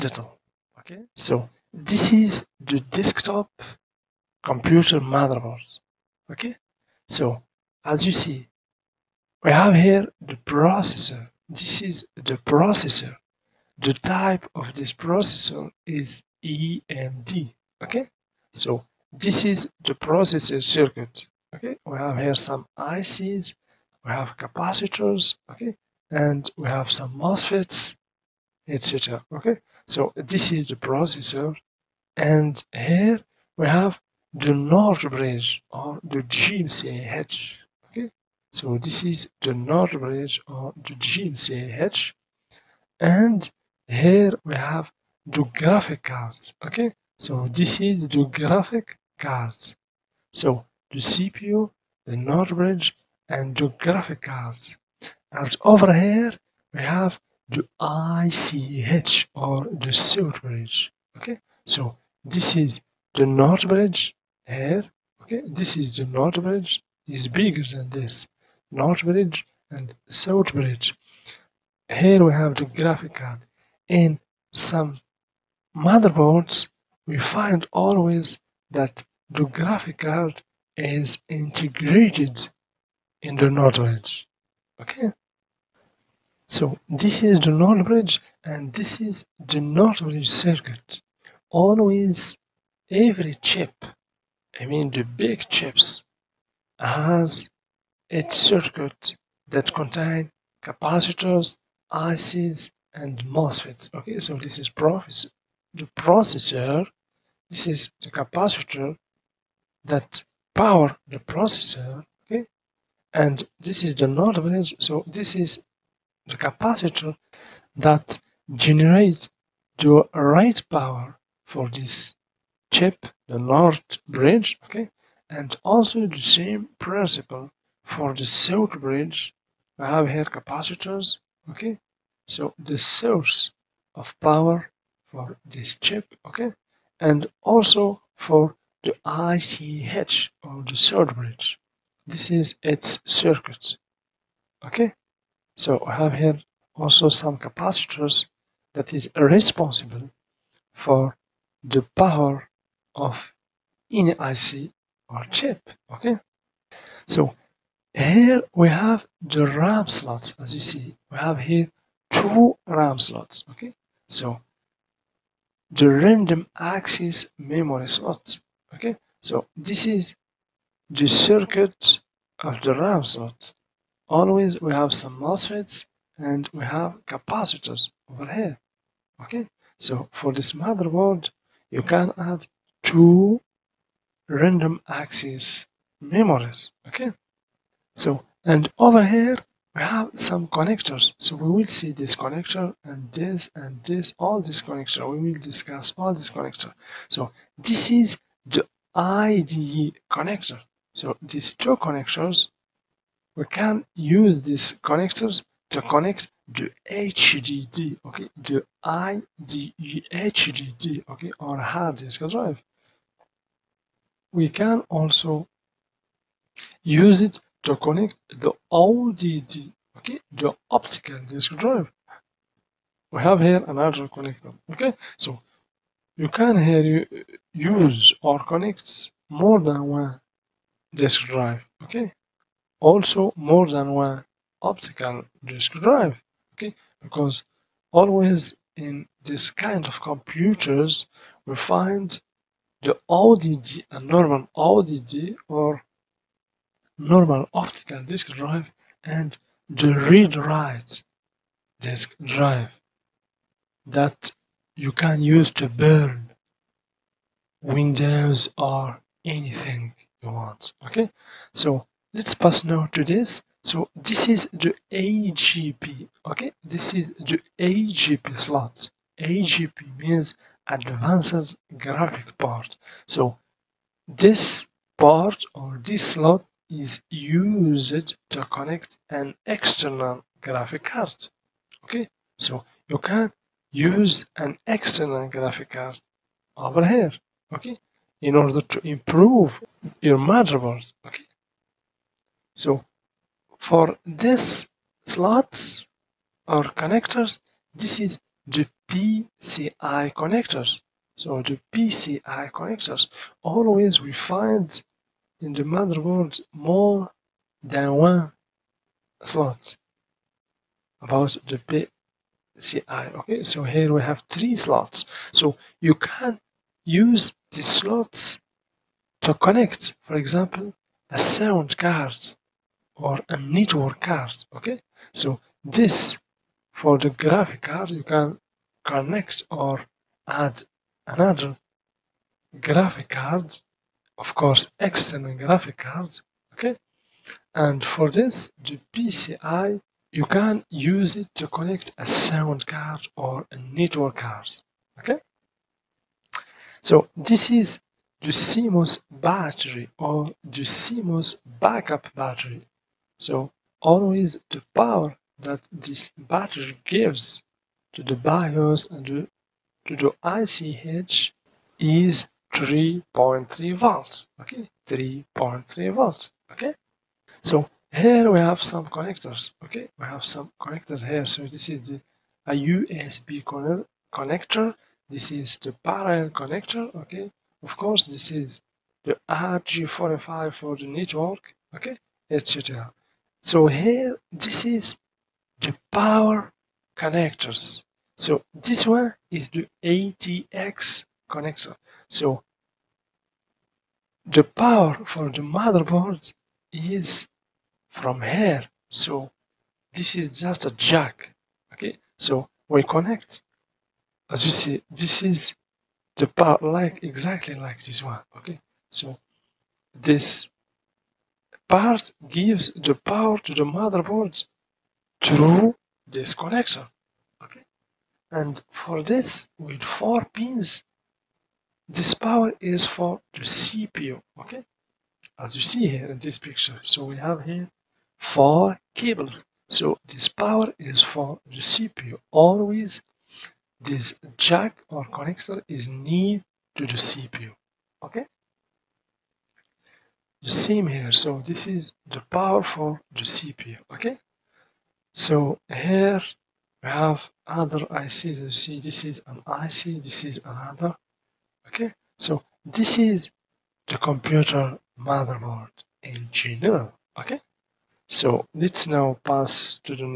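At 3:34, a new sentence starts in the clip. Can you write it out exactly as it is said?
We can also use it to connect the ODD, okay, the optical disk drive.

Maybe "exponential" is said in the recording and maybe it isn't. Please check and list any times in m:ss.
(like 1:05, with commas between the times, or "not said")
not said.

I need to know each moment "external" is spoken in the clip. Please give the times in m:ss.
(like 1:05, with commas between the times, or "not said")
4:39, 4:44, 5:34.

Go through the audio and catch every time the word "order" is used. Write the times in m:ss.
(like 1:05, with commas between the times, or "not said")
4:48.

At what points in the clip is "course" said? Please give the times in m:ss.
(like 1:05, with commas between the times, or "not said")
5:34, 6:17.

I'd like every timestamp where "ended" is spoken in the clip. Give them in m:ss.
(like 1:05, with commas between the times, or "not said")
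not said.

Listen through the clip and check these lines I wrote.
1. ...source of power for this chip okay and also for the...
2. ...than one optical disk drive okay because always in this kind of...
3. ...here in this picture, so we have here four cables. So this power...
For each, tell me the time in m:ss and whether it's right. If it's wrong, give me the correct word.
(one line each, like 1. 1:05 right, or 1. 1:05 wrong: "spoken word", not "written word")
1. 2:12 right
2. 3:53 right
3. 7:05 right.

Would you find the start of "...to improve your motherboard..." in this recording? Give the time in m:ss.
4:48.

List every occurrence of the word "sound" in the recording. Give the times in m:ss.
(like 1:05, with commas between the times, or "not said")
5:21, 5:42.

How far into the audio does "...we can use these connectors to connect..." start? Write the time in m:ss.
3:23.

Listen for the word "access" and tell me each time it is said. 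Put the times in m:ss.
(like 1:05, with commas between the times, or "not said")
2:46, 3:04.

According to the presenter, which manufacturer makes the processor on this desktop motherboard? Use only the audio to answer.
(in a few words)
AMD.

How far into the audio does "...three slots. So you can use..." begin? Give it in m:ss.
5:14.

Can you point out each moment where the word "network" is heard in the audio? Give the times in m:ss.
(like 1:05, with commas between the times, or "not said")
5:23, 5:43, 6:20.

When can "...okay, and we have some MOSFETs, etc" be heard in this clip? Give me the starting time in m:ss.
0:25.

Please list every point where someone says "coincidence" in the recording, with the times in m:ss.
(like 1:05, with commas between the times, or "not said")
not said.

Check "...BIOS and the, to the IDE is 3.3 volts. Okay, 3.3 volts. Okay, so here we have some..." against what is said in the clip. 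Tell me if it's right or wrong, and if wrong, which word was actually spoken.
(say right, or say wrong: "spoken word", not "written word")
wrong: "ICH", not "IDE".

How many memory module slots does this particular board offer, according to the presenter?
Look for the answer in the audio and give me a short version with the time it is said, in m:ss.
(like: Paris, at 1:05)
2, at 2:42.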